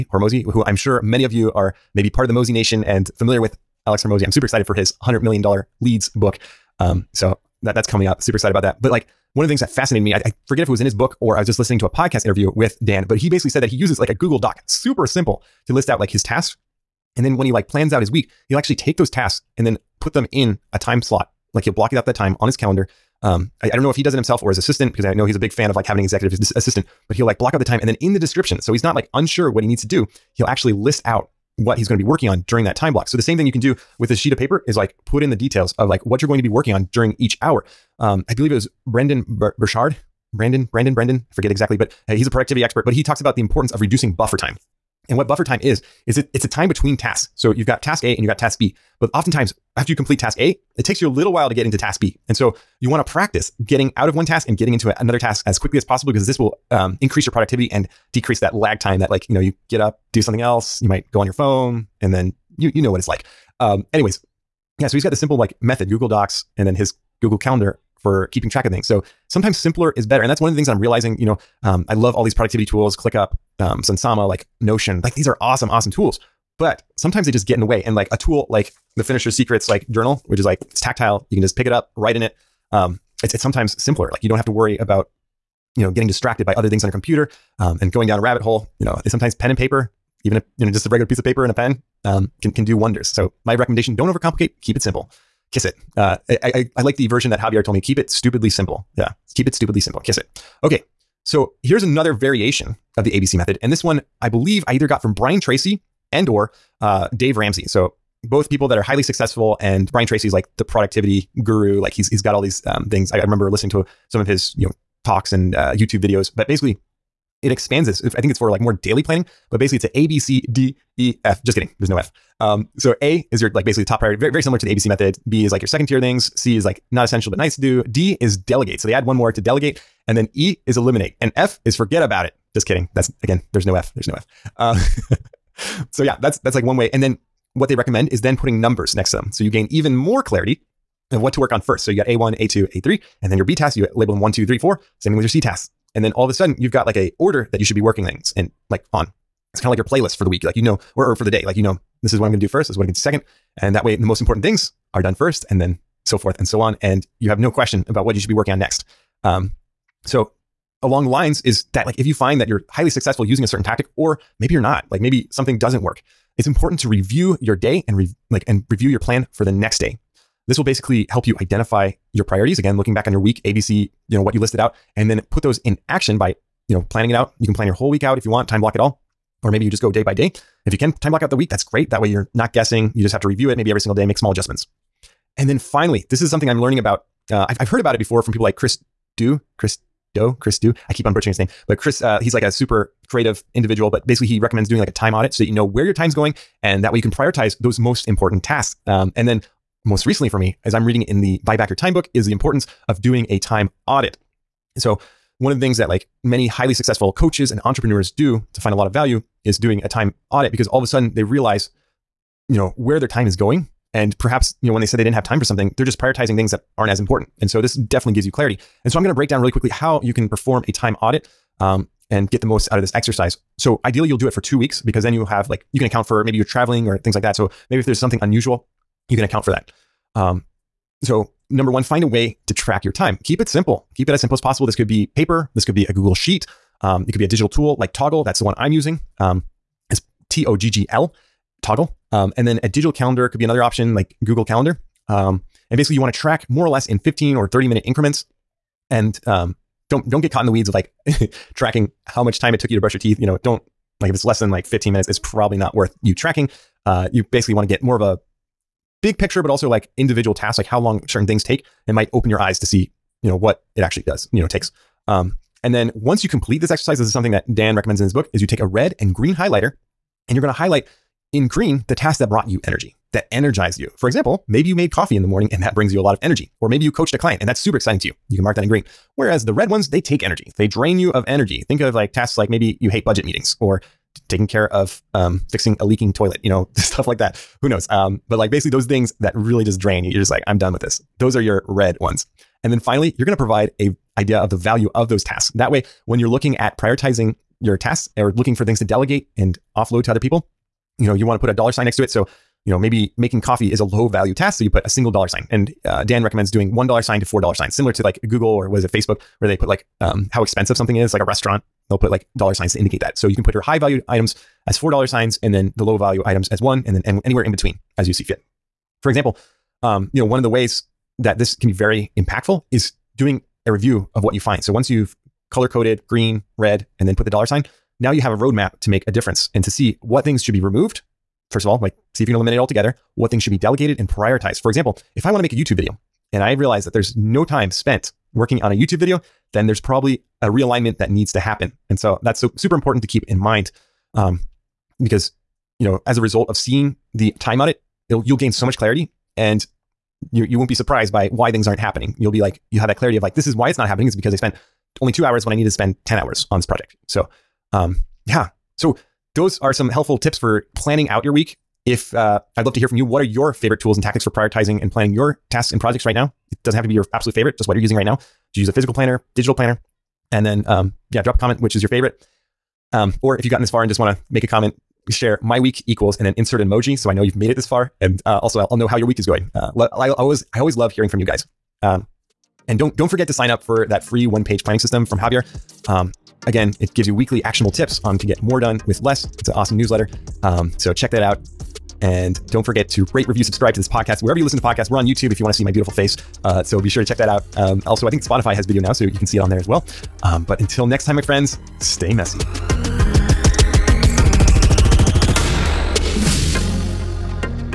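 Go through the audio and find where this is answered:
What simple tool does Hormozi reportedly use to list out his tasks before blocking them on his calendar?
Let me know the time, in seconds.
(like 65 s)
14 s.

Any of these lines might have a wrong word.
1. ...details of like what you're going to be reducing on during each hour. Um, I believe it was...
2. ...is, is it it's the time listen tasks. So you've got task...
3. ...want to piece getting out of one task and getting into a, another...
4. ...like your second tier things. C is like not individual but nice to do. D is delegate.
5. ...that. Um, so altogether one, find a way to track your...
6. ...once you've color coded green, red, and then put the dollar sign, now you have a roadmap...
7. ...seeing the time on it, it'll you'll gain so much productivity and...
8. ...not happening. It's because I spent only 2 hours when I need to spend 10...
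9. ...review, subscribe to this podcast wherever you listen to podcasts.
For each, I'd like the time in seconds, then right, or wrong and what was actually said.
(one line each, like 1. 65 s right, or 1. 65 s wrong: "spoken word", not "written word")
1. 35 s wrong: "working", not "reducing"
2. 45 s wrong: "between", not "listen"
3. 52 s wrong: "practice", not "piece"
4. 125 s wrong: "essential", not "individual"
5. 229 s wrong: "number", not "altogether"
6. 324 s right
7. 346 s wrong: "clarity", not "productivity"
8. 353 s right
9. 393 s right.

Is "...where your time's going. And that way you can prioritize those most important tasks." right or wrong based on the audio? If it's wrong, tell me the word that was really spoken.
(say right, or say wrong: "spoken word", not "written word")
right.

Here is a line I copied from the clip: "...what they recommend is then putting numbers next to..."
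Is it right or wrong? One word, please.
right.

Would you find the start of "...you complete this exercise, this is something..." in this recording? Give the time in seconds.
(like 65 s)
266 s.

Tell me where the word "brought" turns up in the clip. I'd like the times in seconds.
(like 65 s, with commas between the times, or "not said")
272 s.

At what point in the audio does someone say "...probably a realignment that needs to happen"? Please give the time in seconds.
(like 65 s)
339 s.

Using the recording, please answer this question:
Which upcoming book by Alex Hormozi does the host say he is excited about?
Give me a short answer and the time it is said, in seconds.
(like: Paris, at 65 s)
$100 million leads, at 5 s.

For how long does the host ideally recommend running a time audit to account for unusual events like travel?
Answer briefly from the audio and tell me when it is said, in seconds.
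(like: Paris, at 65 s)
2 weeks, at 224 s.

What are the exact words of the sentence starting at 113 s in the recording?
I, I, remember listening to some of his you know talks and uh, YouTube videos, but basically it expands this.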